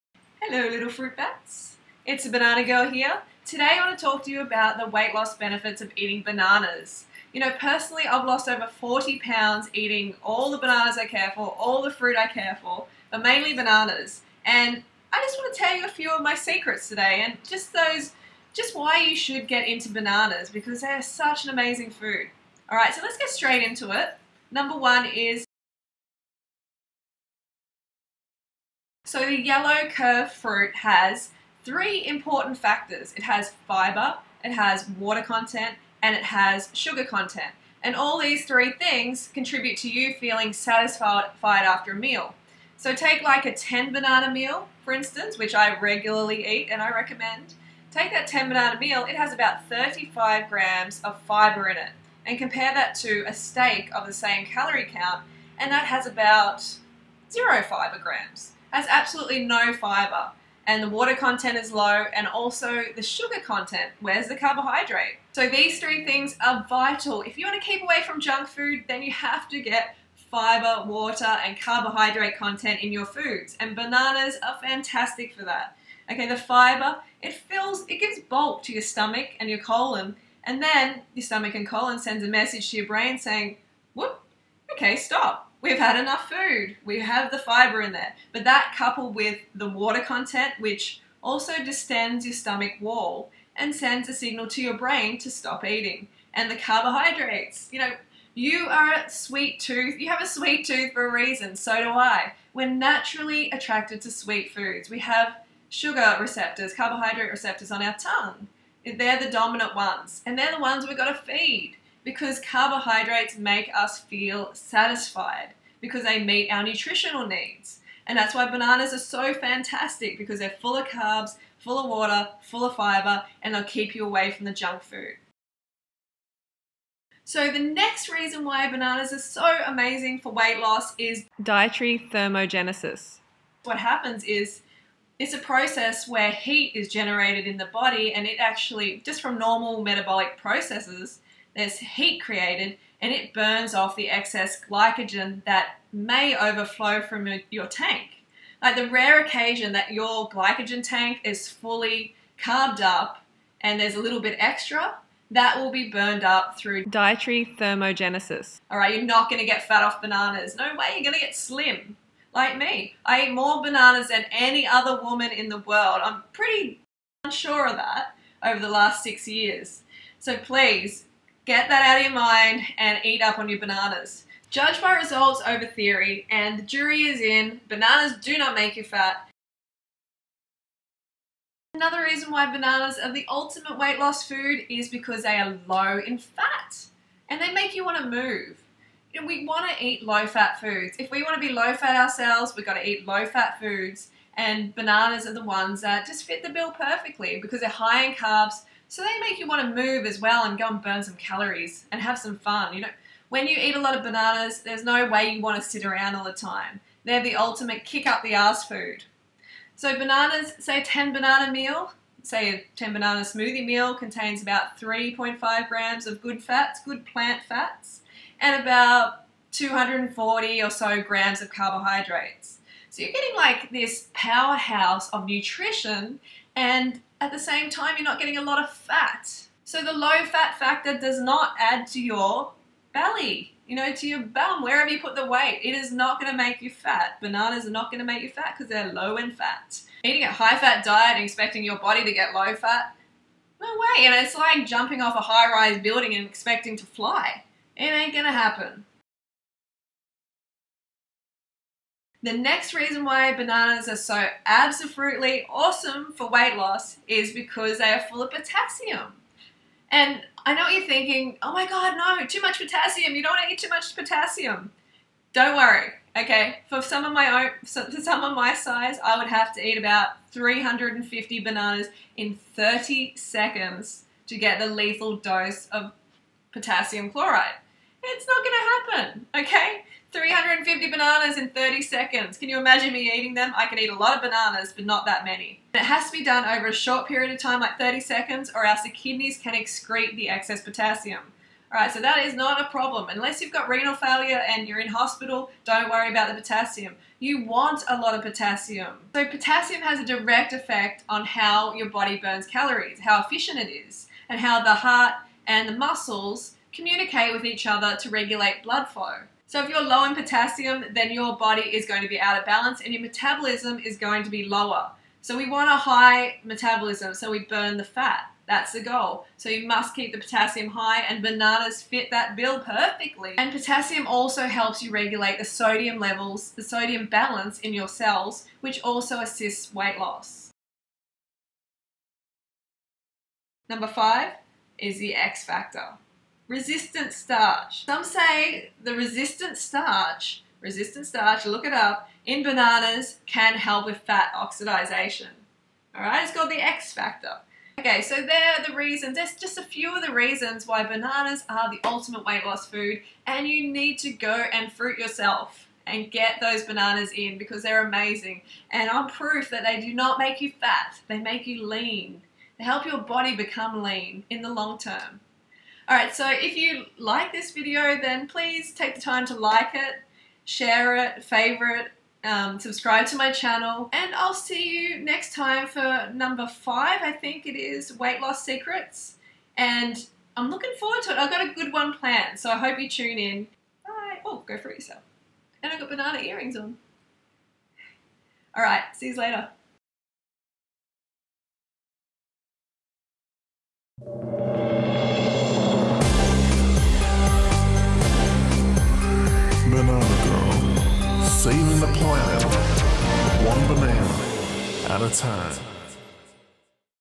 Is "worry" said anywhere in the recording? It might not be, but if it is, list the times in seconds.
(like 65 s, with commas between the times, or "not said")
265 s, 295 s.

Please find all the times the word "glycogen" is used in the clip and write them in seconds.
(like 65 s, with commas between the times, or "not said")
144 s, 150 s.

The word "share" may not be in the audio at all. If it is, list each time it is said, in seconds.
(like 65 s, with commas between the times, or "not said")
370 s.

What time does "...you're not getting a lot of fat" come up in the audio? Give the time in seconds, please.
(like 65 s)
227 s.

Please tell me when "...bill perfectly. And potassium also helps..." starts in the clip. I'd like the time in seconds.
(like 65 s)
322 s.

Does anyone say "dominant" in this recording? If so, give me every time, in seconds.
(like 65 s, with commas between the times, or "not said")
109 s.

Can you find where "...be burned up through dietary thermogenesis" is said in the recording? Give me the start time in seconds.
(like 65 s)
155 s.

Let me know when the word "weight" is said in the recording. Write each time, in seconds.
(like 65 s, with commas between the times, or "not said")
4 s, 130 s, 183 s, 235 s, 256 s, 329 s, 352 s, 377 s.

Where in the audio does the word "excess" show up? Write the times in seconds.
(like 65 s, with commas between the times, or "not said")
144 s, 290 s.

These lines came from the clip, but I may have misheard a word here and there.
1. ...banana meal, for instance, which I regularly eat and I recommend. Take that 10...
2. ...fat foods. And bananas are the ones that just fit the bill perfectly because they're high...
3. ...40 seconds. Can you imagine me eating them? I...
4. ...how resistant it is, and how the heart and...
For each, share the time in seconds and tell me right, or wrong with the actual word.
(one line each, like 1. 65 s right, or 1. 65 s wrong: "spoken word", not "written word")
1. 43 s right
2. 193 s right
3. 281 s wrong: "30", not "40"
4. 302 s wrong: "efficient", not "resistant".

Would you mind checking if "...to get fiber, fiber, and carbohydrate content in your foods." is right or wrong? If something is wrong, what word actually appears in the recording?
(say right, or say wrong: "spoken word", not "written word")
wrong: "water", not "fiber".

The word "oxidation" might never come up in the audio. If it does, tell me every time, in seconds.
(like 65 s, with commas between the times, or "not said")
344 s.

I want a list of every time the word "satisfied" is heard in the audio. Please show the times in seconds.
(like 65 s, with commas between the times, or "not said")
40 s, 114 s.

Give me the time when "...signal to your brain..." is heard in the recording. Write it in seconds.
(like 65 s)
94 s.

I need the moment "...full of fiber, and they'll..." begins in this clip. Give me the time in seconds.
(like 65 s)
122 s.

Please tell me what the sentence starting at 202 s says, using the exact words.
You know, when you eat a lot of bananas, there's no way you want to sit around all the time.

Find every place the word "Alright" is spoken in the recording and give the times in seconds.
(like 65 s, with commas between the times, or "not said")
22 s, 291 s, 365 s.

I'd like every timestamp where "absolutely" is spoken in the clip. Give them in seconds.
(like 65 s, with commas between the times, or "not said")
58 s, 254 s.